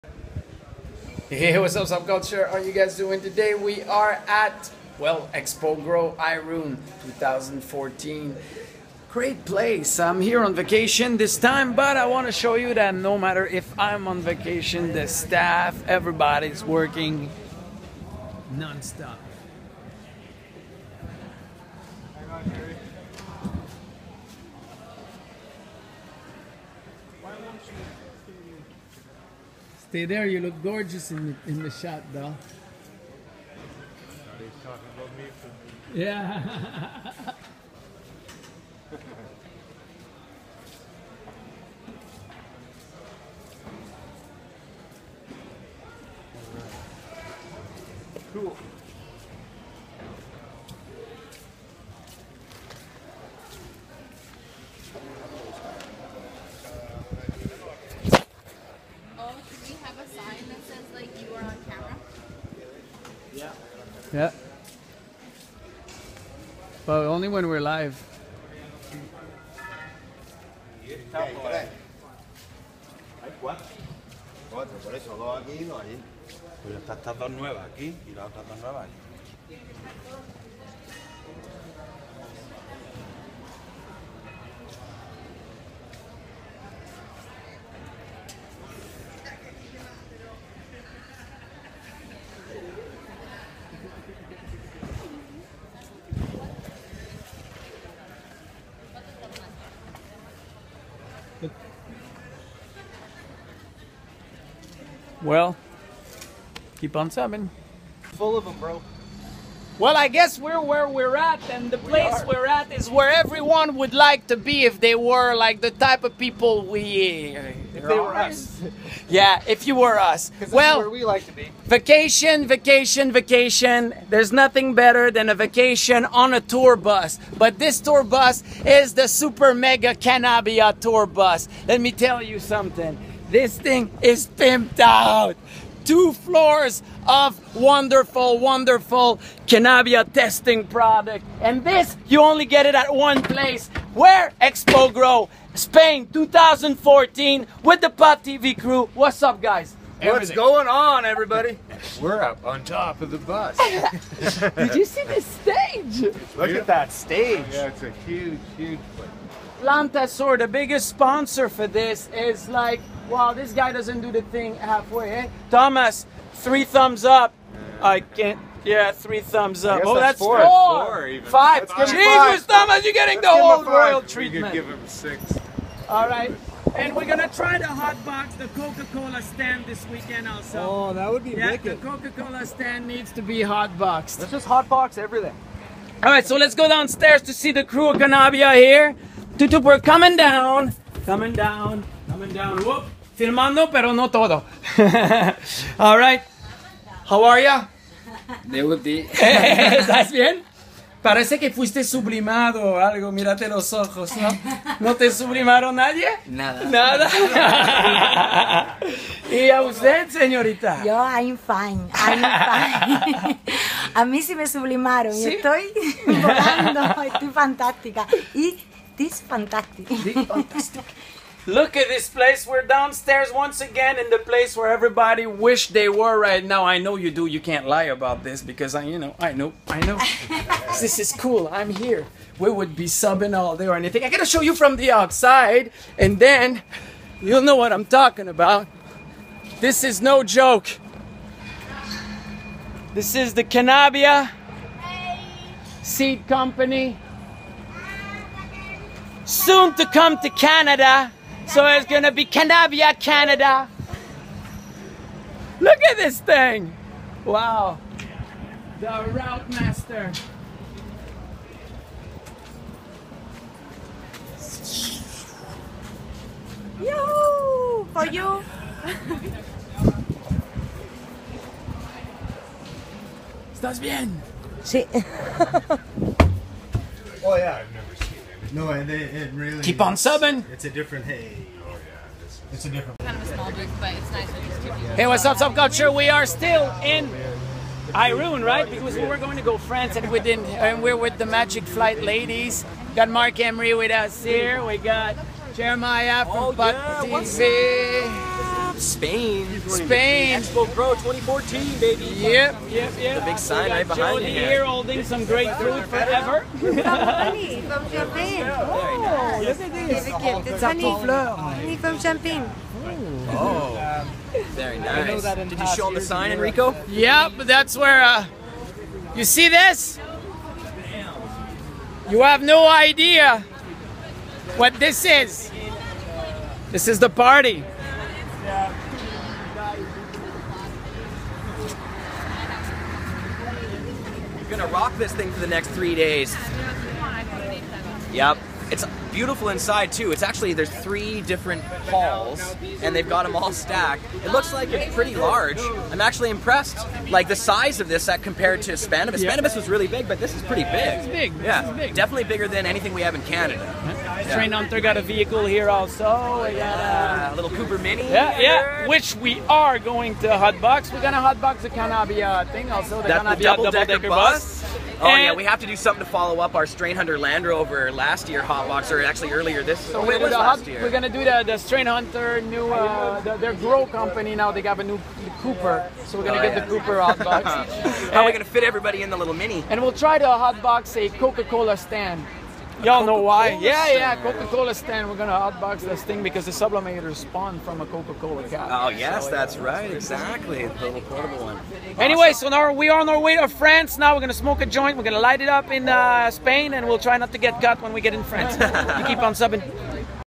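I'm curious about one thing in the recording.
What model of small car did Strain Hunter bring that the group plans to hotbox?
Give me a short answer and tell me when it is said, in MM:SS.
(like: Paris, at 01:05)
Cooper Mini, at 05:57.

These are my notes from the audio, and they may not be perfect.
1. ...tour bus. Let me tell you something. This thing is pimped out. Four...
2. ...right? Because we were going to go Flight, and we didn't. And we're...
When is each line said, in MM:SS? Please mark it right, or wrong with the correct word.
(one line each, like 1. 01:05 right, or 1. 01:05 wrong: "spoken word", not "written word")
1. 02:10 wrong: "Two", not "Four"
2. 04:48 wrong: "France", not "Flight".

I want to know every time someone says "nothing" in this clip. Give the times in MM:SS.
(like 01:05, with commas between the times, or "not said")
02:04.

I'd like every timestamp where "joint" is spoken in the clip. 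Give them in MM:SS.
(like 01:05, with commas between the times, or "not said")
06:34.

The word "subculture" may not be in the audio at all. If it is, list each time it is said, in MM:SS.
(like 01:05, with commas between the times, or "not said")
00:01, 04:45.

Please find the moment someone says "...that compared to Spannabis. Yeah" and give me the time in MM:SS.
05:48.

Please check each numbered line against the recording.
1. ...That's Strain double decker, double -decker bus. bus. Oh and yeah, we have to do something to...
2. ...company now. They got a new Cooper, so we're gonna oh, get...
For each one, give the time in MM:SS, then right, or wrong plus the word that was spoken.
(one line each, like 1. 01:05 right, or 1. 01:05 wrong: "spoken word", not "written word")
1. 06:03 wrong: "Kannabia", not "Strain"
2. 06:13 right.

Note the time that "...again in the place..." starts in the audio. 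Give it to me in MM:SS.
03:43.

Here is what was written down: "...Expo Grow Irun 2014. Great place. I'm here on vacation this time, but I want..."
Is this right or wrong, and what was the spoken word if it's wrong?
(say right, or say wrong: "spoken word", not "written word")
right.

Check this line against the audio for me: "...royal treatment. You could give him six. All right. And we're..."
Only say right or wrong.
right.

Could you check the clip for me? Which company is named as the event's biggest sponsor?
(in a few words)
Plantasor.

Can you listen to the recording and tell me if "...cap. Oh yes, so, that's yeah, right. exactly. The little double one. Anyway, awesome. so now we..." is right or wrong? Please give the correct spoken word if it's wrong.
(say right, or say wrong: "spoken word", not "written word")
wrong: "portable", not "double".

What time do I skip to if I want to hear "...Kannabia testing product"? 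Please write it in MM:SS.
02:19.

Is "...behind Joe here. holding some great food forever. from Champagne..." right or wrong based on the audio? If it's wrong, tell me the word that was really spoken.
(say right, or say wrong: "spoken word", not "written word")
right.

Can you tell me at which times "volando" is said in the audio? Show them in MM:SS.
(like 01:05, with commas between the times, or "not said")
03:36.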